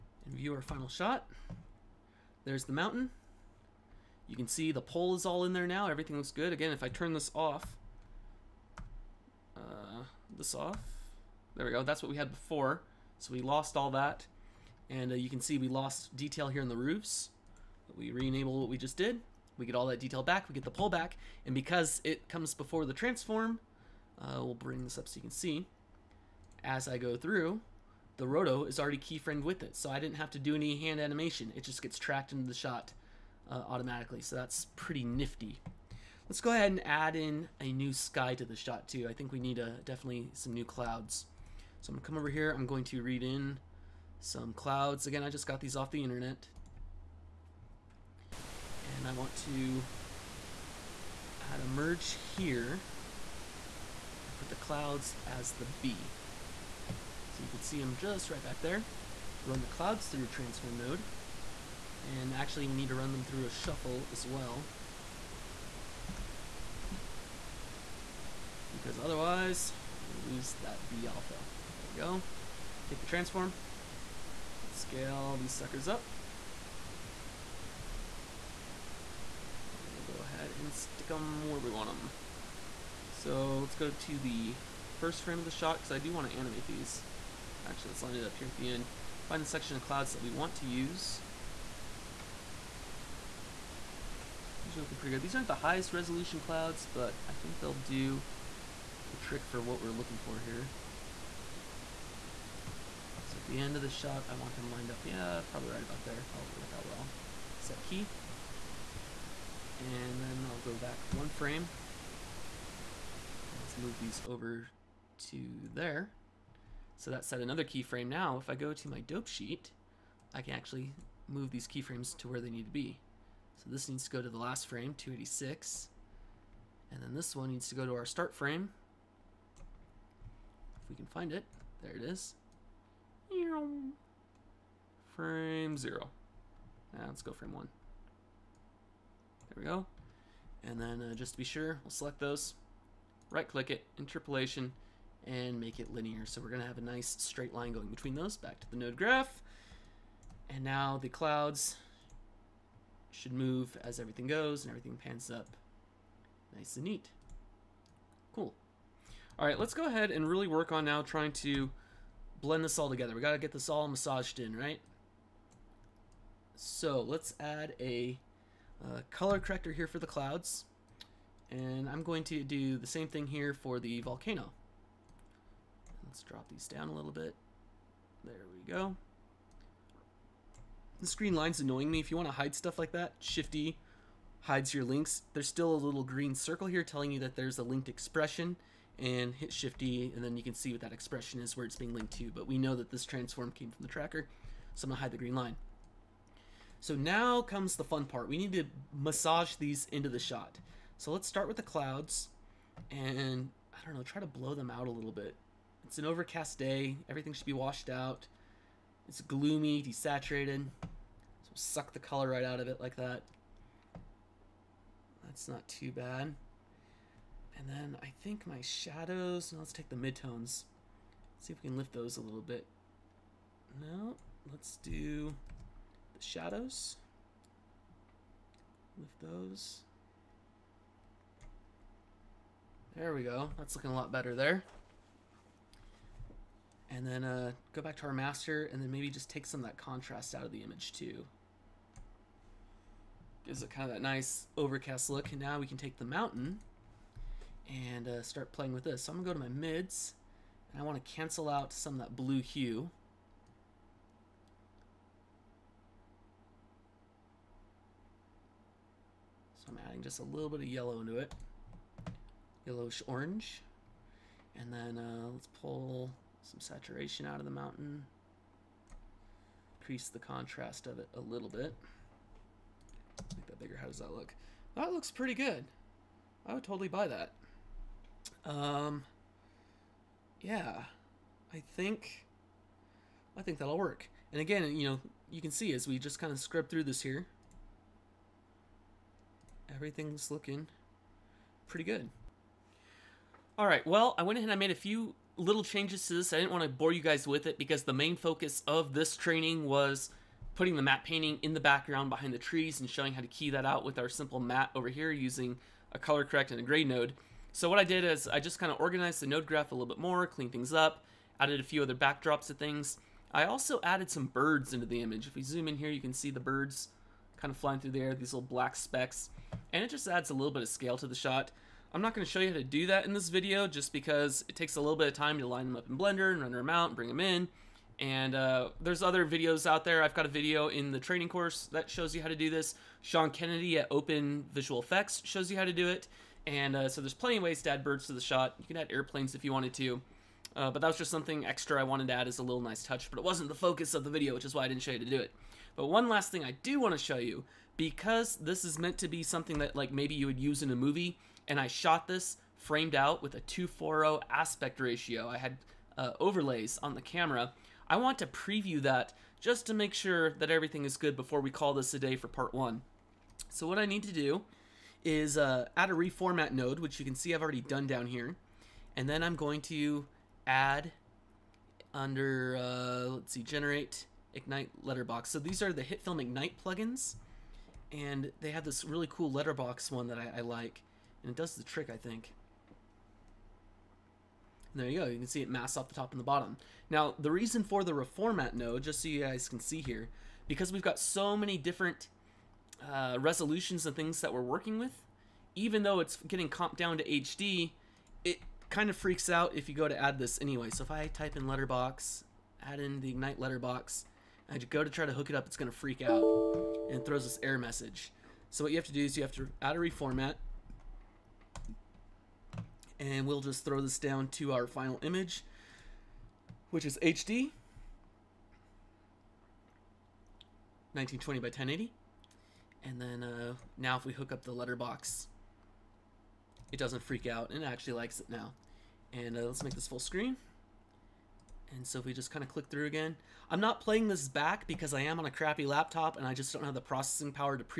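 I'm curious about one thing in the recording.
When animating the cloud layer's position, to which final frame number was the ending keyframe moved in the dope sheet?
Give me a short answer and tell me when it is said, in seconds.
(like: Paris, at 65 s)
286, at 124 s.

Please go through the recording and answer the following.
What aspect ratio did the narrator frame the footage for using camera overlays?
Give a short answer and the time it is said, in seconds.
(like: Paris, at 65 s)
2.40, at 353 s.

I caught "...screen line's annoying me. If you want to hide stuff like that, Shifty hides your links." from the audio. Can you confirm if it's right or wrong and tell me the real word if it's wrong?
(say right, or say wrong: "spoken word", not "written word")
right.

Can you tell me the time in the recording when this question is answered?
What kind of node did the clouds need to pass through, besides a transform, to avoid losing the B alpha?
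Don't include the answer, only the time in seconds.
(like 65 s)
63 s.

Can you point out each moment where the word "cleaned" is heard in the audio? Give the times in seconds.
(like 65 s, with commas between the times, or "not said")
310 s.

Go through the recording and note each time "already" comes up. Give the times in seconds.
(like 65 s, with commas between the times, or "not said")
28 s, 367 s.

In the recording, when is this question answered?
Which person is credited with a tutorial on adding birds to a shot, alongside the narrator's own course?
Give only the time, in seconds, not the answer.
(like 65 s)
333 s.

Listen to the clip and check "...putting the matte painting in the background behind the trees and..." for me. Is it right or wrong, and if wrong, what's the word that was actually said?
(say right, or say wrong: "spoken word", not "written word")
right.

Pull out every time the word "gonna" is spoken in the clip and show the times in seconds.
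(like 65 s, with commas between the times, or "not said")
41 s, 146 s, 194 s, 249 s.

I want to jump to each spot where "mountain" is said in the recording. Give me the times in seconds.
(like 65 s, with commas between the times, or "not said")
2 s, 246 s, 267 s.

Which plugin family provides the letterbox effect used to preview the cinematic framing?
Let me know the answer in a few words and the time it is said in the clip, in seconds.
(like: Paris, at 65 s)
HitFilm Ignite, at 375 s.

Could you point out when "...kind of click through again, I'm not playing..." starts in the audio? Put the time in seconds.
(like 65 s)
432 s.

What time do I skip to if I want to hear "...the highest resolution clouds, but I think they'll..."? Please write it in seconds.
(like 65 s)
95 s.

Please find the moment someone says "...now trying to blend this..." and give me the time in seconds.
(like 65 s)
160 s.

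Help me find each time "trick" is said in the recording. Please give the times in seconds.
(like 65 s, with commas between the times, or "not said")
99 s, 381 s.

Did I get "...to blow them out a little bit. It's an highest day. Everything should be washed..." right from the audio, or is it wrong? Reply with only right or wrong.
wrong.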